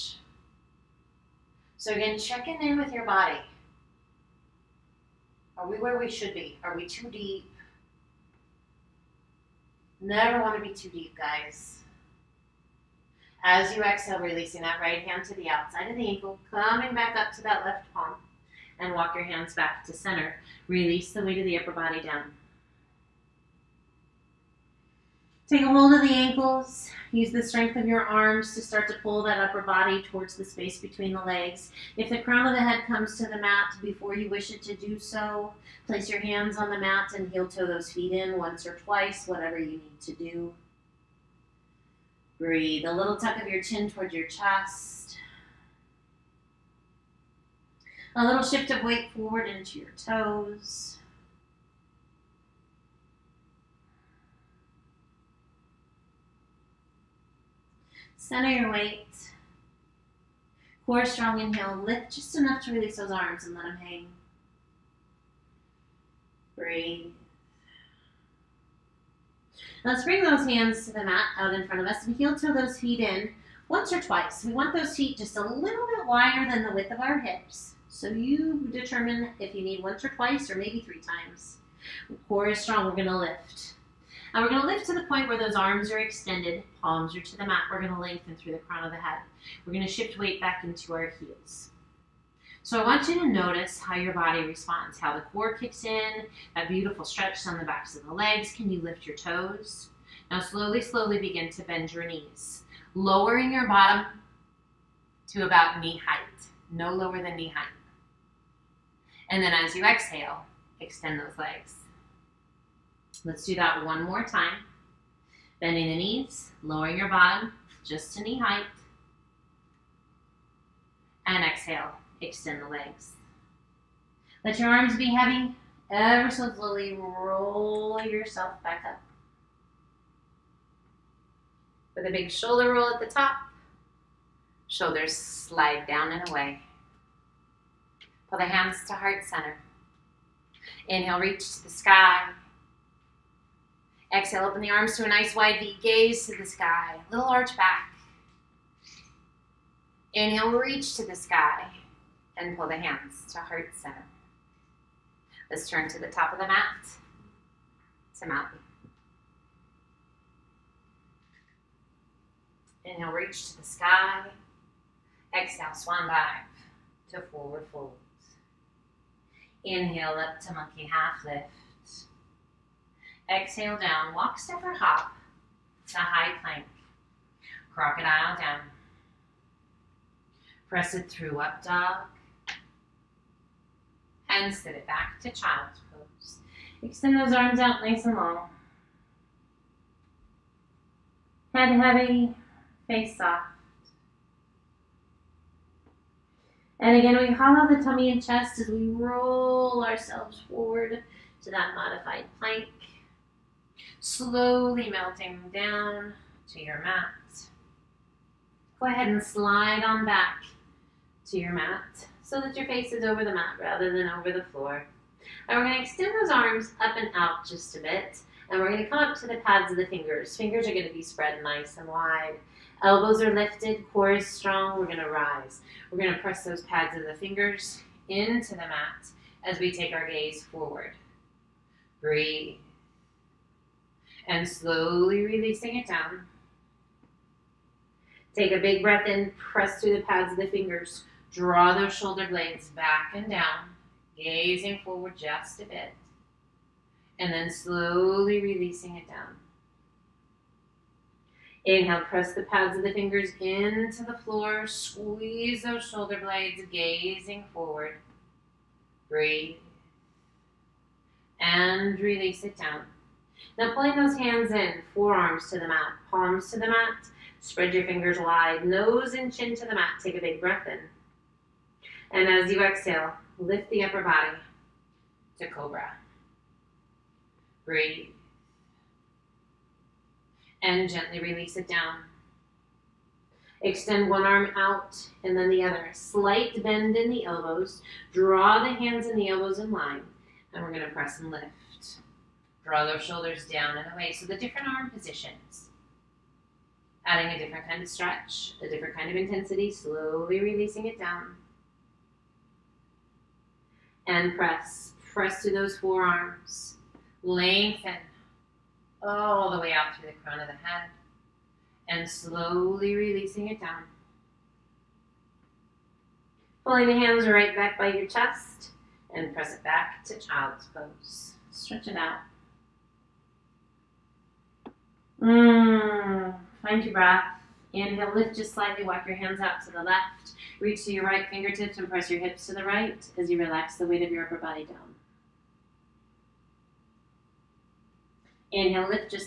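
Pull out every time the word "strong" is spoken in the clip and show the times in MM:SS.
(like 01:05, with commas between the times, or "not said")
01:01, 01:22, 03:44.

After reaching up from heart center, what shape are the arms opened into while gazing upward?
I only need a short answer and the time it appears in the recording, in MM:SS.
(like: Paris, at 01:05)
wide V, at 02:25.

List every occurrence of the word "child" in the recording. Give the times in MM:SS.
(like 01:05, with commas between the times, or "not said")
03:05, 05:20.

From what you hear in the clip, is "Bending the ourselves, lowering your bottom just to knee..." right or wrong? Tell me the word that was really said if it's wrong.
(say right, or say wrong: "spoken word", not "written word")
wrong: "knees", not "ourselves".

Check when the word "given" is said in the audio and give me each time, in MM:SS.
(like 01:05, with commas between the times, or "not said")
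not said.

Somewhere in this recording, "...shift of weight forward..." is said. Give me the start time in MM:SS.
00:48.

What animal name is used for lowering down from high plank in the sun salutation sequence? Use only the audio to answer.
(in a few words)
crocodile.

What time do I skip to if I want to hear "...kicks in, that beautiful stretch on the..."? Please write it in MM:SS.
01:35.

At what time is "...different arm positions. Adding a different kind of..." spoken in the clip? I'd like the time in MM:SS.
04:54.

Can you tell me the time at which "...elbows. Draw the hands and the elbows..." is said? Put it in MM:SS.
04:47.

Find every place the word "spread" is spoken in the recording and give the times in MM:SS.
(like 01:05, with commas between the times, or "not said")
03:41, 04:27.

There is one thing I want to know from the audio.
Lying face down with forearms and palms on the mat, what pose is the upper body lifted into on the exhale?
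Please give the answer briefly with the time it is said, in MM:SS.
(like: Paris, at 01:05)
cobra, at 04:35.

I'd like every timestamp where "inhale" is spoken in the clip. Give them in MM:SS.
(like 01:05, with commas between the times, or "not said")
01:01, 02:20, 02:30, 02:42, 02:49, 04:11, 05:27, 05:38.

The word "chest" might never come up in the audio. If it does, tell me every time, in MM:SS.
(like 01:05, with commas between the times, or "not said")
00:44, 03:18, 05:18.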